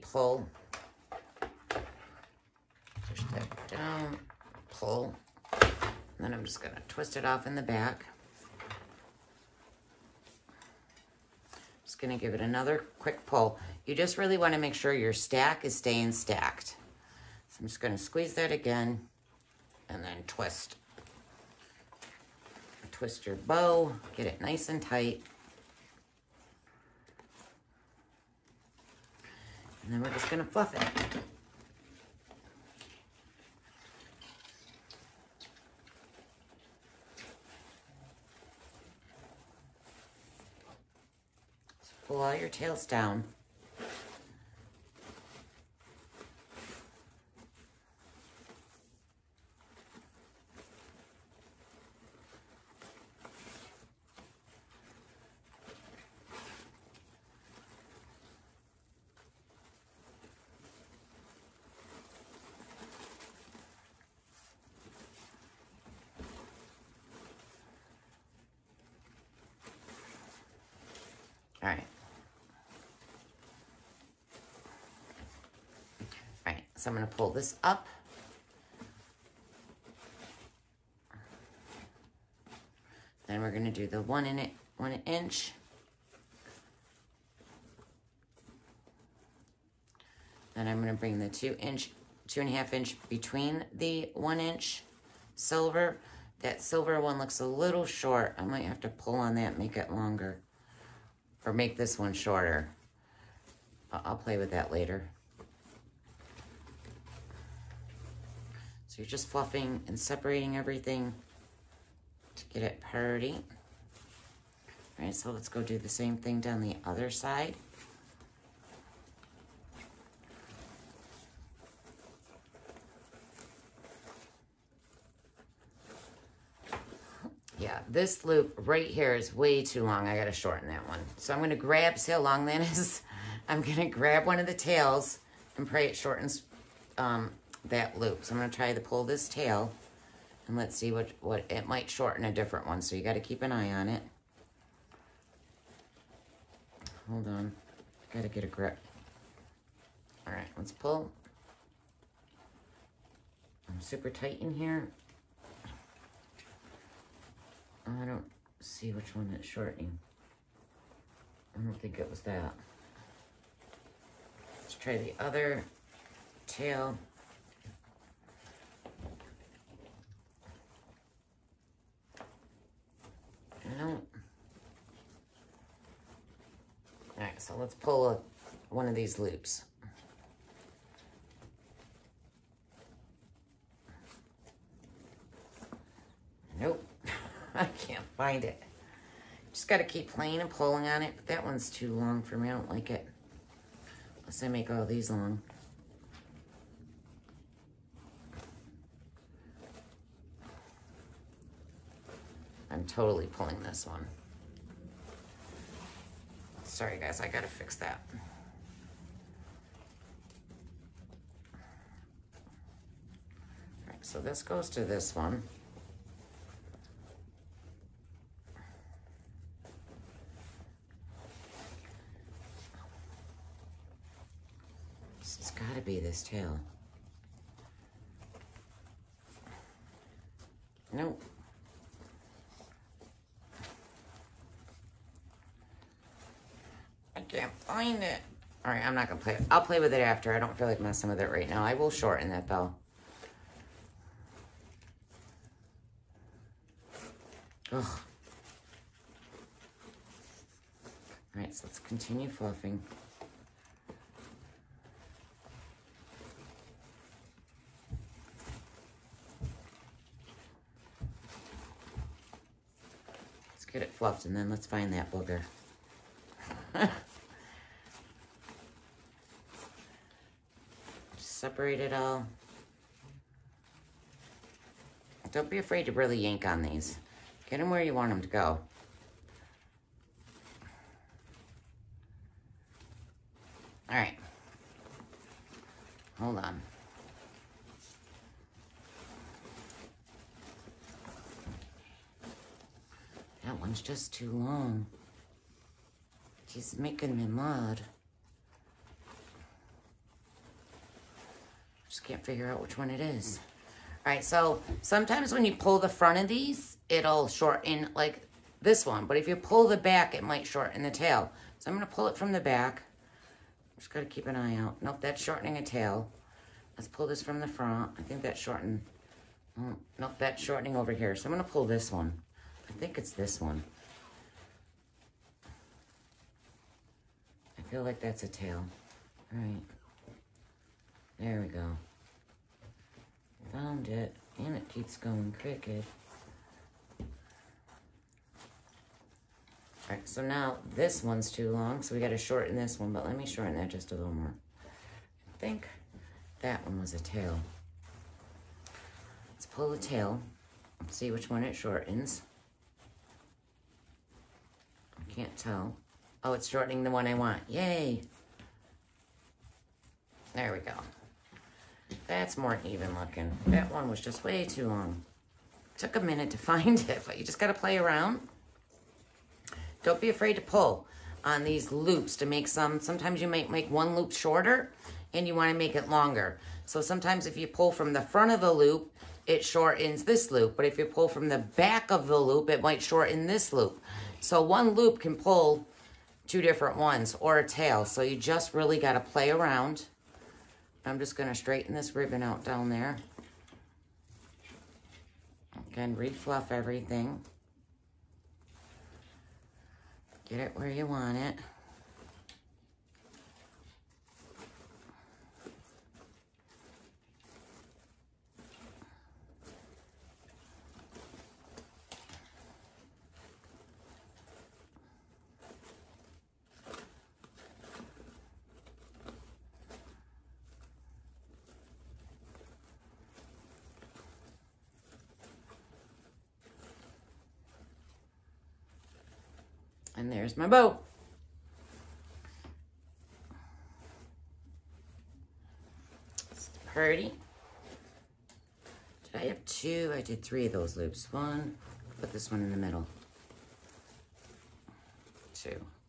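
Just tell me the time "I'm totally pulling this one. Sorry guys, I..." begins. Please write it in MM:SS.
03:22.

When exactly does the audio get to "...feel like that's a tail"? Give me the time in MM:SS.
05:27.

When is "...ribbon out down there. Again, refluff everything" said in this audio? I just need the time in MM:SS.
06:31.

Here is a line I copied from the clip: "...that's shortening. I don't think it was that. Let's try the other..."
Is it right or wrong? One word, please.
right.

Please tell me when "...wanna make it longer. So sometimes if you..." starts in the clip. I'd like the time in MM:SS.
06:15.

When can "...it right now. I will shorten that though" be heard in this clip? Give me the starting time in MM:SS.
04:01.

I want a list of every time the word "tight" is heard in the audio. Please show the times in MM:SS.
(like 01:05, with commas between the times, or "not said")
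00:24, 02:34.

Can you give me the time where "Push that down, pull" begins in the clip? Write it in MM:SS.
00:03.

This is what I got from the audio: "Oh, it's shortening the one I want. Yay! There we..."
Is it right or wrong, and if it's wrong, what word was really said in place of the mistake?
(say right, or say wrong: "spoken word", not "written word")
right.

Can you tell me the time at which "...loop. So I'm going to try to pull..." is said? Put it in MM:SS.
02:17.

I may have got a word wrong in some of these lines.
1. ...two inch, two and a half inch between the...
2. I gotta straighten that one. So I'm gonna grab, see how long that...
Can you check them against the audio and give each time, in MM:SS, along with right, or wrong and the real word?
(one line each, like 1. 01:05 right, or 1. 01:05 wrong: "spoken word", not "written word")
1. 01:31 right
2. 02:10 wrong: "shorten", not "straighten".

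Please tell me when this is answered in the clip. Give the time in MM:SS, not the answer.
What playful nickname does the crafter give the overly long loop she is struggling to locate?
04:25.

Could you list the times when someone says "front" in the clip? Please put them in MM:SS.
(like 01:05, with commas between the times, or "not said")
05:05, 05:17, 06:18.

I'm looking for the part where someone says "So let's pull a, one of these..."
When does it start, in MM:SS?
02:57.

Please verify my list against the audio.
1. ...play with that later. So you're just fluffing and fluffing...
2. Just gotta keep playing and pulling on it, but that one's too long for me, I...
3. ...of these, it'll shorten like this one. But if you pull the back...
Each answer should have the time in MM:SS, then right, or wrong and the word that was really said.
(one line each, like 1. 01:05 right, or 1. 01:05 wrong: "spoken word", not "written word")
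1. 01:44 wrong: "separating", not "fluffing"
2. 03:09 right
3. 05:06 right.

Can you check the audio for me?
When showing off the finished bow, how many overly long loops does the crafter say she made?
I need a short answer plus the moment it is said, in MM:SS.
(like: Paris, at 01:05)
3, at 07:20.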